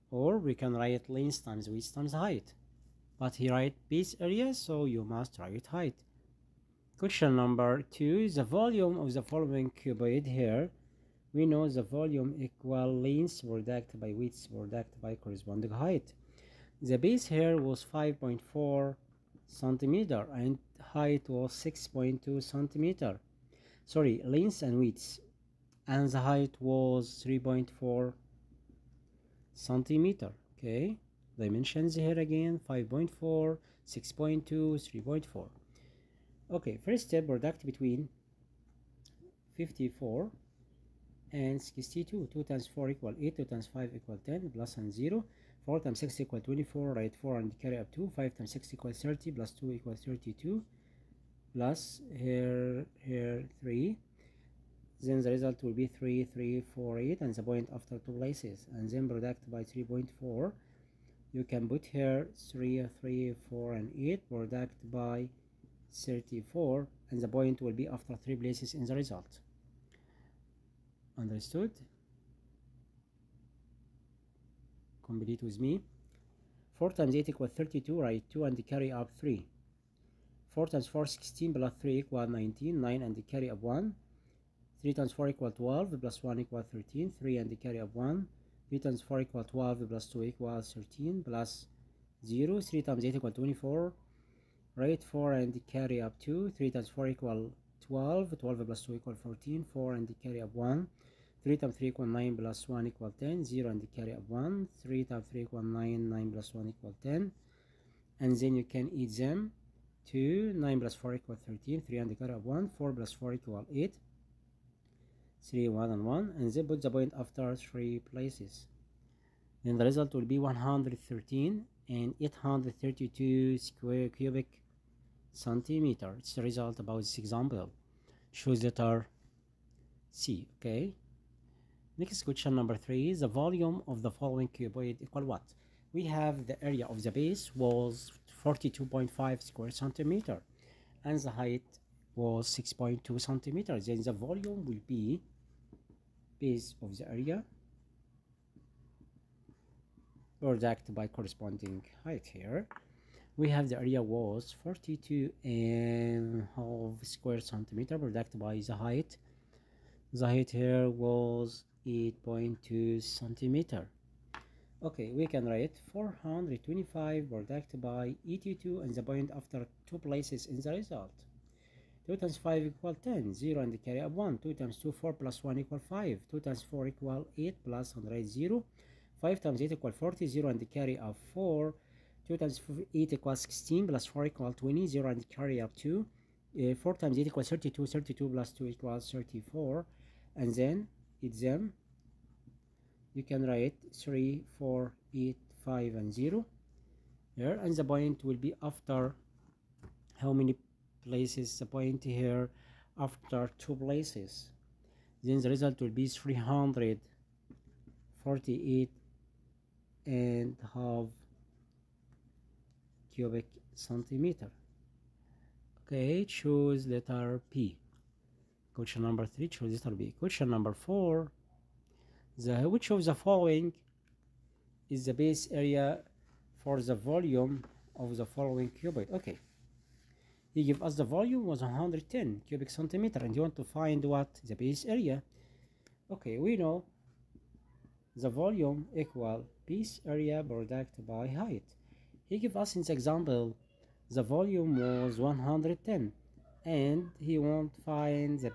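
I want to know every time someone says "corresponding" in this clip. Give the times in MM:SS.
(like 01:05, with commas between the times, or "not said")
00:15, 02:31.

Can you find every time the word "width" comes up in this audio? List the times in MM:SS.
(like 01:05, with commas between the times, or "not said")
00:01, 00:14, 00:24.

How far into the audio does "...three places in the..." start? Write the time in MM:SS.
01:08.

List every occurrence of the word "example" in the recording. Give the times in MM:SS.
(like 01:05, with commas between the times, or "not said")
02:07, 04:02.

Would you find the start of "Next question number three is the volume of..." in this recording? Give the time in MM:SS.
02:11.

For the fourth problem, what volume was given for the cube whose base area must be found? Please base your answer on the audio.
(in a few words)
110 cubic centimeter.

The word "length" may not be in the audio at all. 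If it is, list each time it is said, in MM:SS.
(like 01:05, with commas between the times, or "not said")
00:01, 00:13, 00:24.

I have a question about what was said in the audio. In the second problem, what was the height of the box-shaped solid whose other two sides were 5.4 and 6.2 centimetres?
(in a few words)
3.4 centimeter.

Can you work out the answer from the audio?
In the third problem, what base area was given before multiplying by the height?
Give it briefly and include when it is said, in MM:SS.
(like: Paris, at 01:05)
42.5 square centimeter, at 02:18.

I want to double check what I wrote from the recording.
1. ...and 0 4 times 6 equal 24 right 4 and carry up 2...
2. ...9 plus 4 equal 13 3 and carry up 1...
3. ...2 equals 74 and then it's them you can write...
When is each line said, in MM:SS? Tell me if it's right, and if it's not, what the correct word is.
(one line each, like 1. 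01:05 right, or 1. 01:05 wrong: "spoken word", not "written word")
1. 00:44 right
2. 01:50 right
3. 03:08 wrong: "34", not "74".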